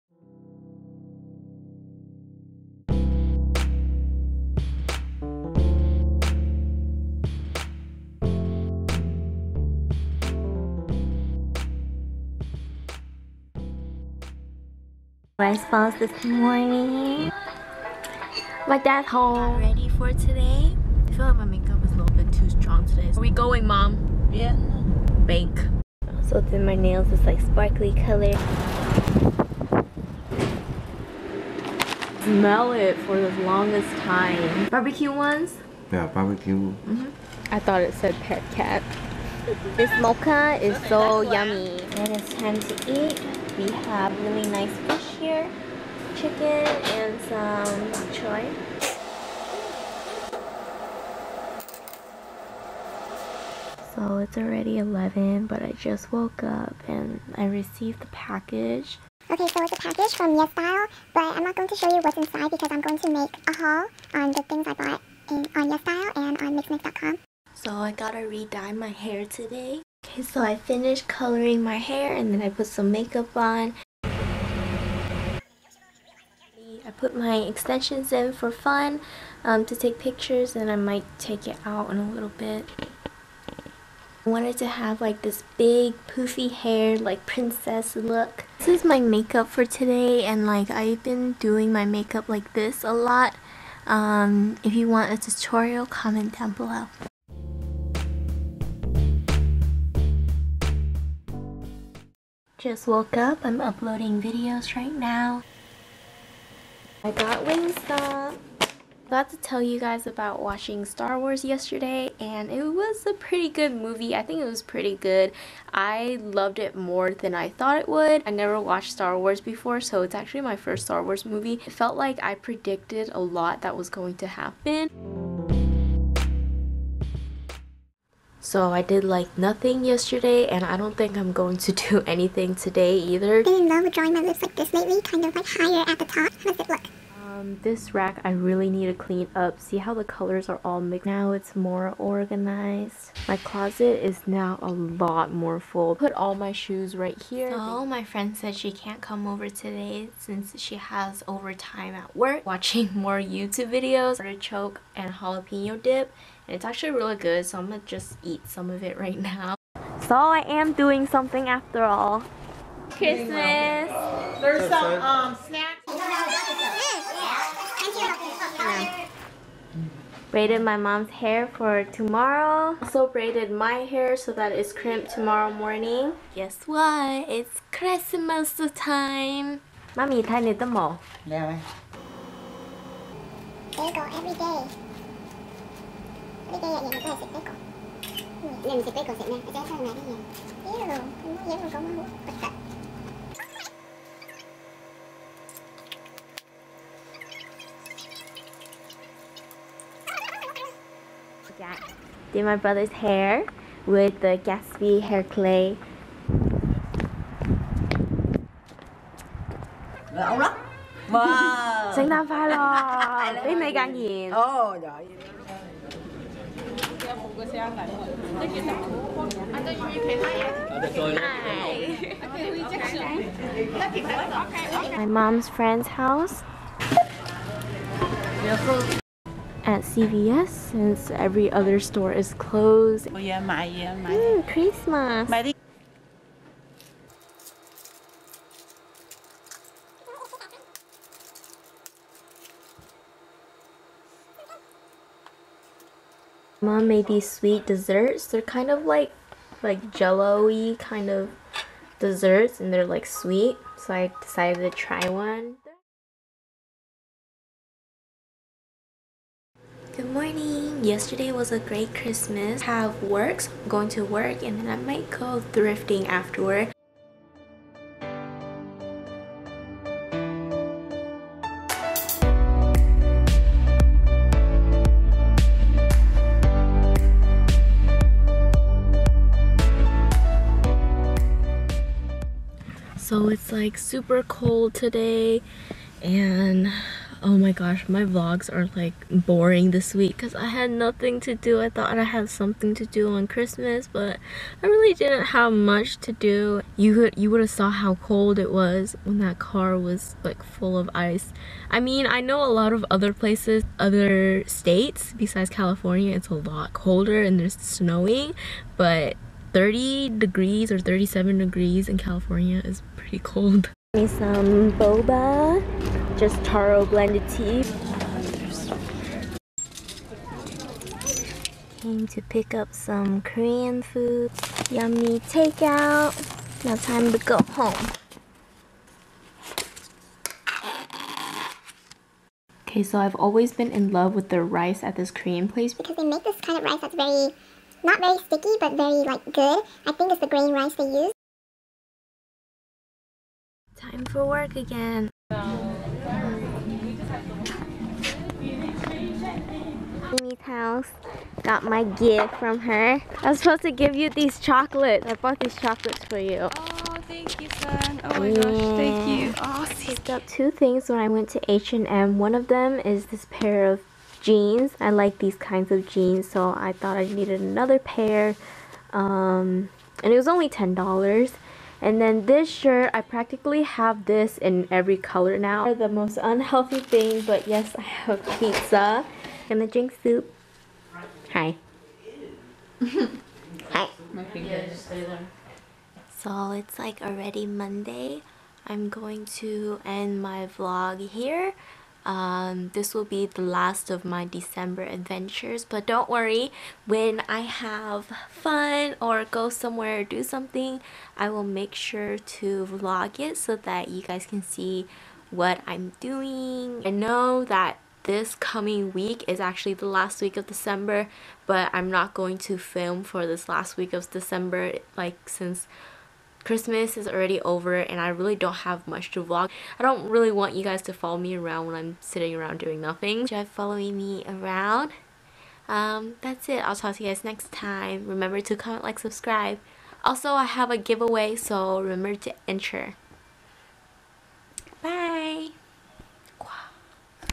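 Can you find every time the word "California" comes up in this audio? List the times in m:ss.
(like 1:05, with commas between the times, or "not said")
5:05, 5:11.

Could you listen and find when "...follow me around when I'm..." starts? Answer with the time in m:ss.
7:00.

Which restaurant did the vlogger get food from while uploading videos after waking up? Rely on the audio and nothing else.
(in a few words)
Wingstop.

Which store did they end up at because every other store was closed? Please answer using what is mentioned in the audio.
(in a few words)
CVS.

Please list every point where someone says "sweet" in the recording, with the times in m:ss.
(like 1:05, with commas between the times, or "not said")
4:07, 4:13.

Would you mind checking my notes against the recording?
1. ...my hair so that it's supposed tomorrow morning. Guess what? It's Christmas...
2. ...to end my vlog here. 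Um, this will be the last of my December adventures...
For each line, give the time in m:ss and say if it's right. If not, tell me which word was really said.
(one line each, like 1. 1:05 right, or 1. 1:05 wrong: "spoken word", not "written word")
1. 2:53 wrong: "crimped", not "supposed"
2. 6:29 right.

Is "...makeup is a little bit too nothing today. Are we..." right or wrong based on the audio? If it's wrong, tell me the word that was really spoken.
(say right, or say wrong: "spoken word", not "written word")
wrong: "strong", not "nothing".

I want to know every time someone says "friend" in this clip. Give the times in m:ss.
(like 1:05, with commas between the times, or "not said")
2:28, 3:45.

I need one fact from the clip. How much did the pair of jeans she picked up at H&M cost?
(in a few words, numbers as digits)
$10.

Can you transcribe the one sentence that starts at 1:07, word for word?
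So I gotta re-dye my hair today.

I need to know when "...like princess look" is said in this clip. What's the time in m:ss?
1:26.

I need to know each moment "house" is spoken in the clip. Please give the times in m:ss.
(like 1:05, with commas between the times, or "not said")
3:45, 5:50.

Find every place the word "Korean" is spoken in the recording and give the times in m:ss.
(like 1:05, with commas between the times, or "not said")
5:23, 5:35.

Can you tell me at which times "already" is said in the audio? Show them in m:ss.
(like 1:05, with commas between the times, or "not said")
0:54, 6:27, 6:57.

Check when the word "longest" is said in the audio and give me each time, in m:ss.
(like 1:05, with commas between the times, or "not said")
0:33.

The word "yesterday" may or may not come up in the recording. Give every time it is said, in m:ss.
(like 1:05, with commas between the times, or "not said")
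1:51, 2:09, 4:20.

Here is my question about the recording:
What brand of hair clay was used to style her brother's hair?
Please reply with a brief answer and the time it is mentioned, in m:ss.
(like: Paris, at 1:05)
Gatsby, at 3:24.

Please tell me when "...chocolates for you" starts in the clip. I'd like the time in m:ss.
5:55.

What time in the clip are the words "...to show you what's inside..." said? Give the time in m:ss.
1:01.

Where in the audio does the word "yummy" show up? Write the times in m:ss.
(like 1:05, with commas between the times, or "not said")
0:41, 5:24.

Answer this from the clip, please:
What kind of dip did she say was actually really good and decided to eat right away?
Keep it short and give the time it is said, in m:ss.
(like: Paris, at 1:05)
Artichoke and jalapeno dip, at 2:34.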